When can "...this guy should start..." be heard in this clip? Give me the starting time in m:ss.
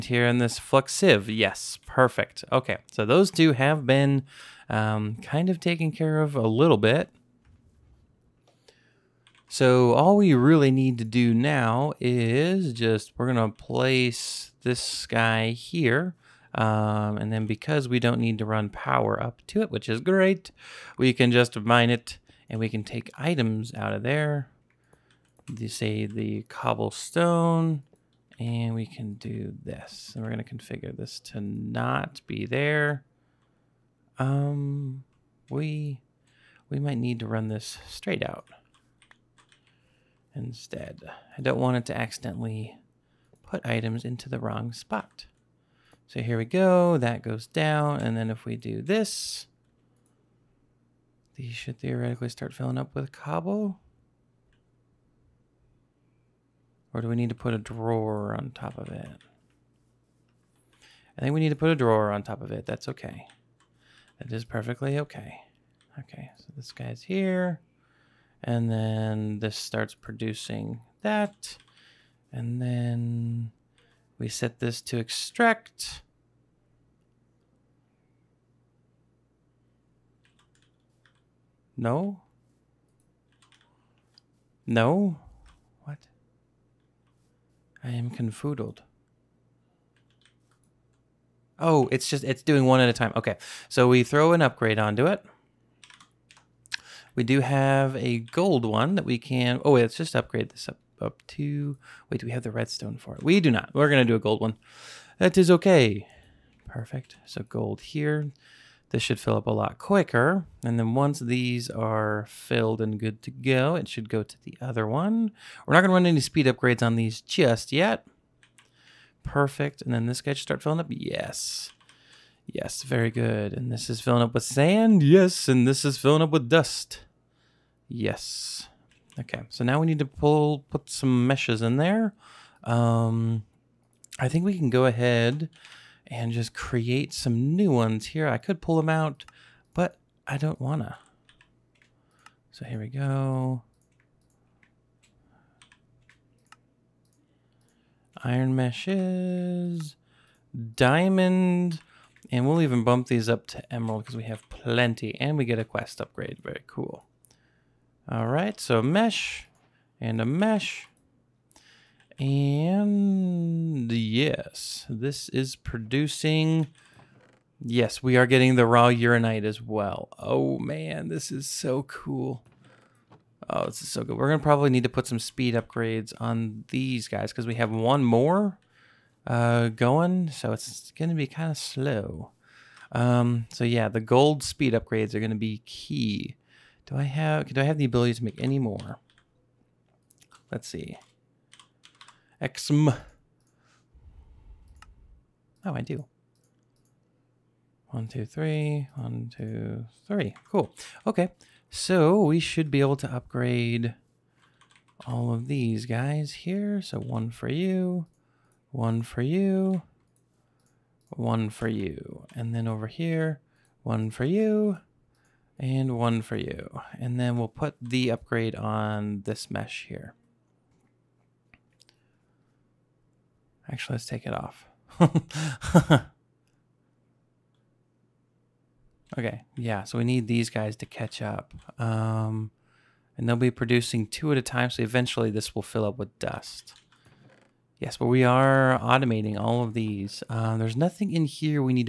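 2:00.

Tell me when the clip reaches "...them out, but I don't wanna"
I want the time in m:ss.
2:18.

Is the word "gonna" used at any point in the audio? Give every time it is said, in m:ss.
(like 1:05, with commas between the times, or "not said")
0:13, 0:30, 1:43, 1:55.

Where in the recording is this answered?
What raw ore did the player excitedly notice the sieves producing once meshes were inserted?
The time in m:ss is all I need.
2:48.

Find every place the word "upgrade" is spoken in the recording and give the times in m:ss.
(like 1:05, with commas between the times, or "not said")
1:34, 1:40, 1:56, 2:36, 2:55, 3:04, 3:23, 3:38.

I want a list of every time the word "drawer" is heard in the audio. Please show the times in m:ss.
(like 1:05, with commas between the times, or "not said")
0:57, 1:01.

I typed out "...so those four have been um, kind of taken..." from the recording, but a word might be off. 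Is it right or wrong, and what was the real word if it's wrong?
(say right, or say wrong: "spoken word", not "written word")
wrong: "two", not "four".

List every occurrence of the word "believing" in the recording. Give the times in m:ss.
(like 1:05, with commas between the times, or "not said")
not said.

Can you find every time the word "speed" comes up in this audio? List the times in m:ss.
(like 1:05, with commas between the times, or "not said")
1:56, 2:55, 3:04.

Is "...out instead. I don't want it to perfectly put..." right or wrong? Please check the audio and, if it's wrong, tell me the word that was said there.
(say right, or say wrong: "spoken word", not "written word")
wrong: "accidentally", not "perfectly".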